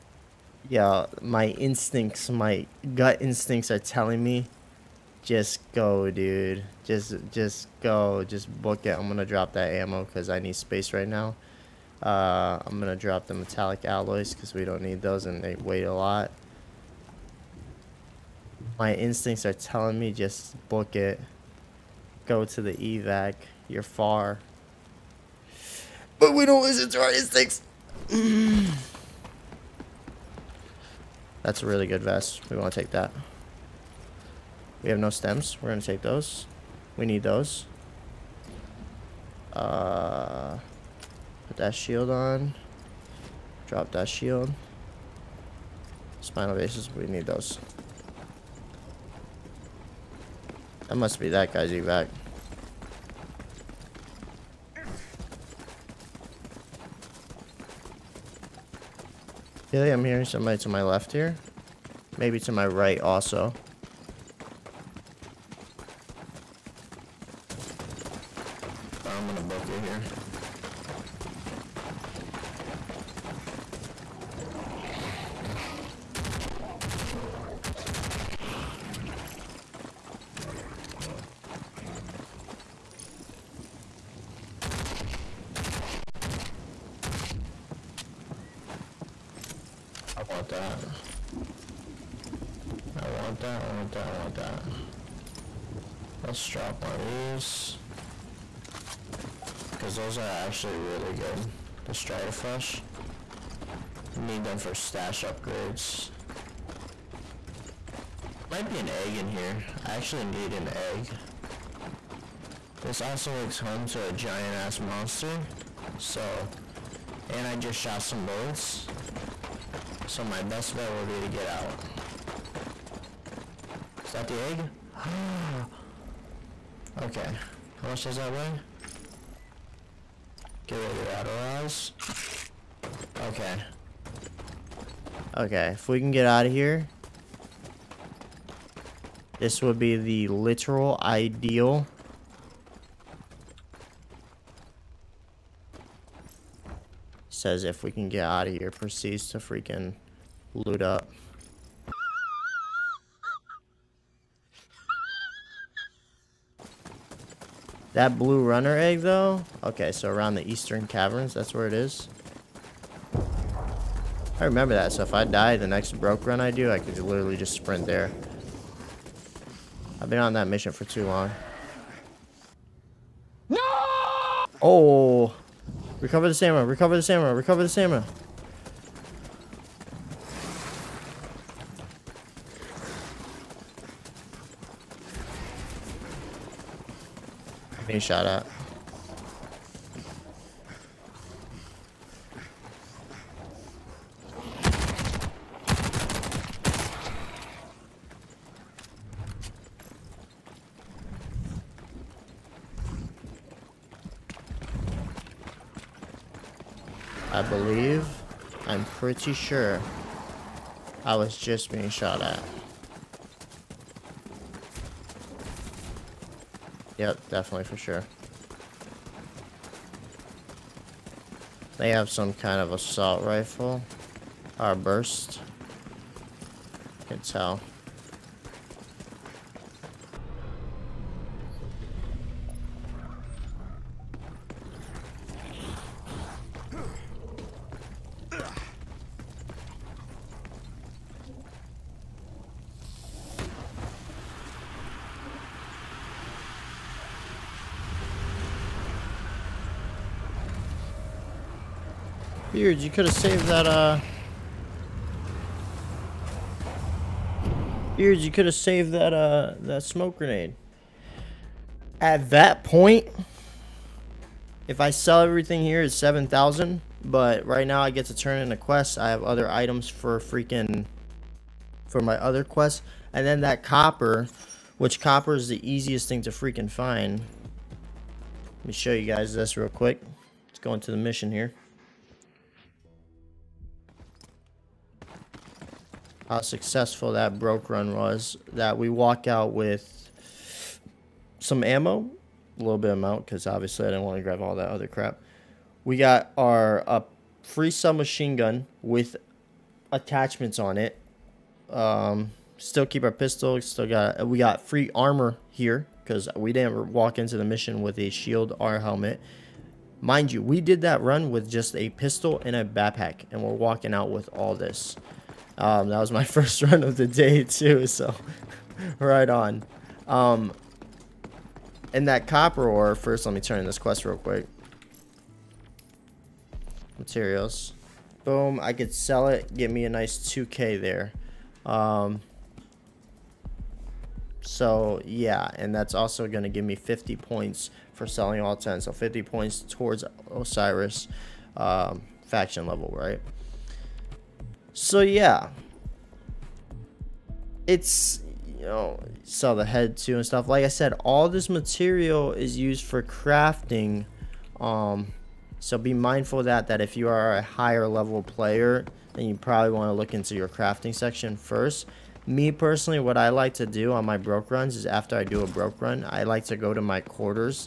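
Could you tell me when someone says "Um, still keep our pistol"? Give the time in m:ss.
5:01.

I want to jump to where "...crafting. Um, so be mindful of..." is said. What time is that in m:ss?
5:53.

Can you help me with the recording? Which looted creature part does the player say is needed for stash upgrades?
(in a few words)
Strider flesh.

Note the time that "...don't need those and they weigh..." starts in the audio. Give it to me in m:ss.
0:14.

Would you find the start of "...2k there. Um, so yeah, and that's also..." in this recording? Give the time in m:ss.
5:30.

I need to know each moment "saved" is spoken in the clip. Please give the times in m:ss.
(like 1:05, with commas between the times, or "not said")
4:13, 4:18.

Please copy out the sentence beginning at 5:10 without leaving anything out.
Mind you, we did that run with just a pistol and a backpack, and we're walking out with all this.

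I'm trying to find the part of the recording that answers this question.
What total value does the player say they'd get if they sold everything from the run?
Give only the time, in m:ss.
4:25.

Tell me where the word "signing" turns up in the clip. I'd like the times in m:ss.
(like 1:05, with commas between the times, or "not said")
not said.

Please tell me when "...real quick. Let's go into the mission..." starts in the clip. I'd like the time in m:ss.
4:39.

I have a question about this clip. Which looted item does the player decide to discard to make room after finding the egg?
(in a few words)
Rattler eyes.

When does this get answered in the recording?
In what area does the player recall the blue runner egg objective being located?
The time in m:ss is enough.
2:40.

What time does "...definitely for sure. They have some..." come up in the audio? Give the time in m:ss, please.
3:37.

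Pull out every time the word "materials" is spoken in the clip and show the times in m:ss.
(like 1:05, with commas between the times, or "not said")
5:26, 5:51.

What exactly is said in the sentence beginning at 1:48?
Might be an egg in here.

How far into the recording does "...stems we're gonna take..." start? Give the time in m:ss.
0:35.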